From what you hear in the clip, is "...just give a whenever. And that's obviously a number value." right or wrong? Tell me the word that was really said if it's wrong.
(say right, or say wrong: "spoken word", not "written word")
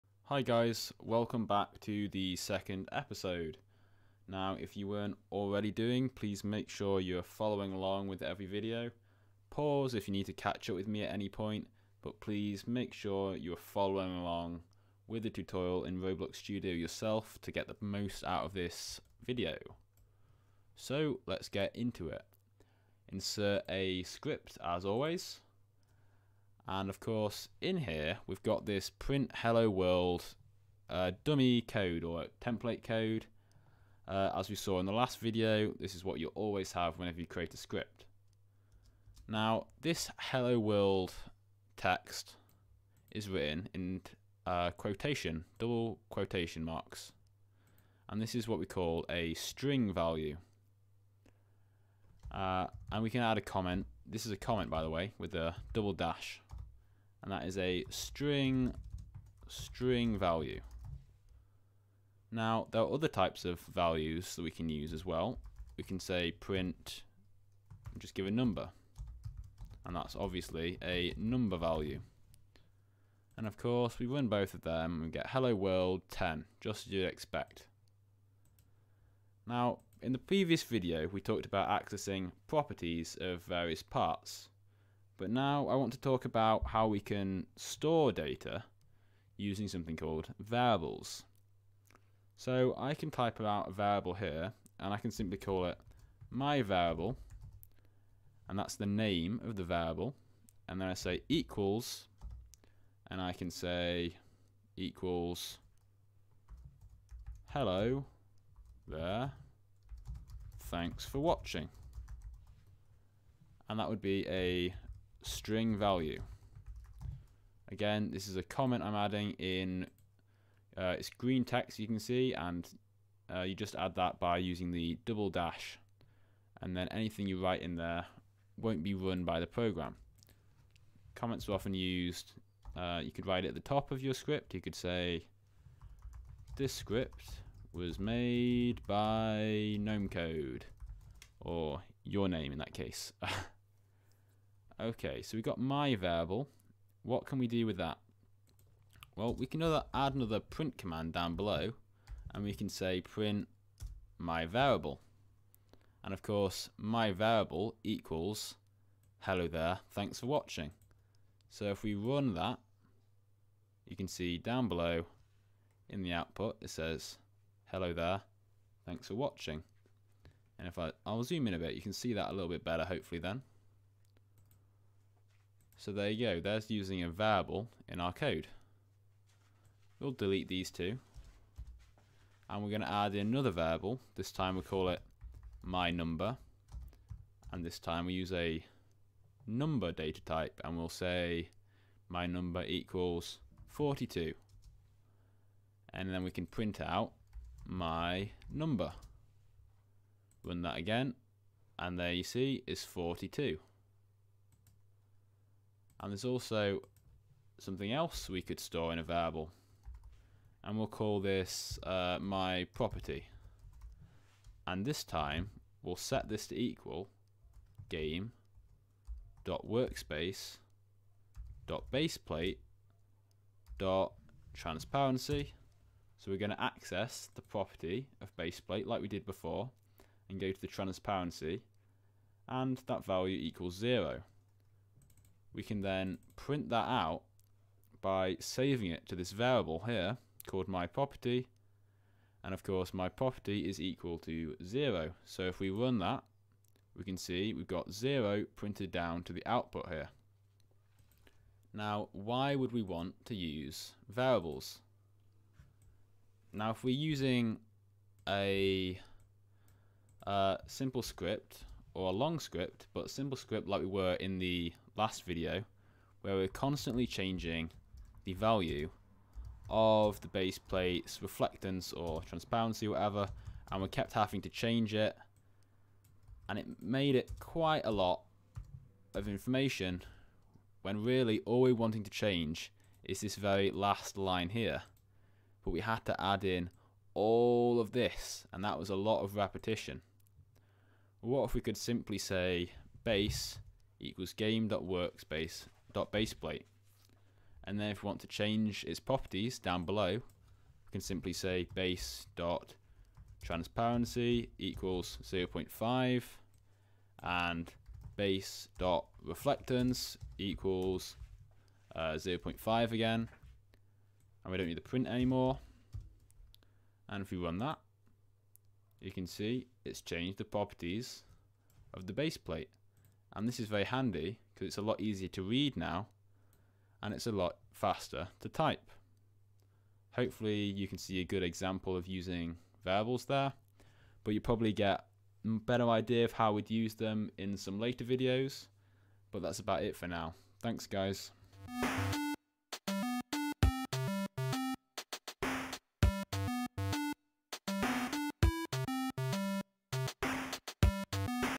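wrong: "number", not "whenever".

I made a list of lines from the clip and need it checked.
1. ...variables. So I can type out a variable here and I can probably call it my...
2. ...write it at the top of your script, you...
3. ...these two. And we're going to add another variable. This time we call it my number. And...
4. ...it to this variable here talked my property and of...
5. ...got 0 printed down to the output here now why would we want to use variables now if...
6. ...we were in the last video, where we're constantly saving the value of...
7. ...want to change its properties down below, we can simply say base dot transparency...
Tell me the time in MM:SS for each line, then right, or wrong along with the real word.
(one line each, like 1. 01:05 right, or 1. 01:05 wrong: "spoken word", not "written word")
1. 01:30 wrong: "simply", not "probably"
2. 02:13 right
3. 03:00 right
4. 03:58 wrong: "called", not "talked"
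5. 04:07 right
6. 04:23 wrong: "changing", not "saving"
7. 04:58 right.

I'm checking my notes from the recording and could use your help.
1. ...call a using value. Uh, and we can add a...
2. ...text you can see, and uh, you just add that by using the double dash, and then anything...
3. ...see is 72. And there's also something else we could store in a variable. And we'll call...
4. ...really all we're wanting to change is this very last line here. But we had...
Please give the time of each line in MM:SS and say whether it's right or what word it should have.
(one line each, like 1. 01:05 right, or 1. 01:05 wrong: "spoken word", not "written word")
1. 00:48 wrong: "string", not "using"
2. 02:01 right
3. 03:22 wrong: "42", not "72"
4. 04:41 right.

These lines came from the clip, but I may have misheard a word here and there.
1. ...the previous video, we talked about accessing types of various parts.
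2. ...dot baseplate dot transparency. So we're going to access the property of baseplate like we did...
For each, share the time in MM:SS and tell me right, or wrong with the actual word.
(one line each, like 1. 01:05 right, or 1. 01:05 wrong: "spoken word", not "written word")
1. 01:20 wrong: "properties", not "types"
2. 03:41 right.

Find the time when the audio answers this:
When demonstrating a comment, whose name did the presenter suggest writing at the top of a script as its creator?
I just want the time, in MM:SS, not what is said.
02:19.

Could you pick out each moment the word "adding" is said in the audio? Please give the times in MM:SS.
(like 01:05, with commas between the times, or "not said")
01:58.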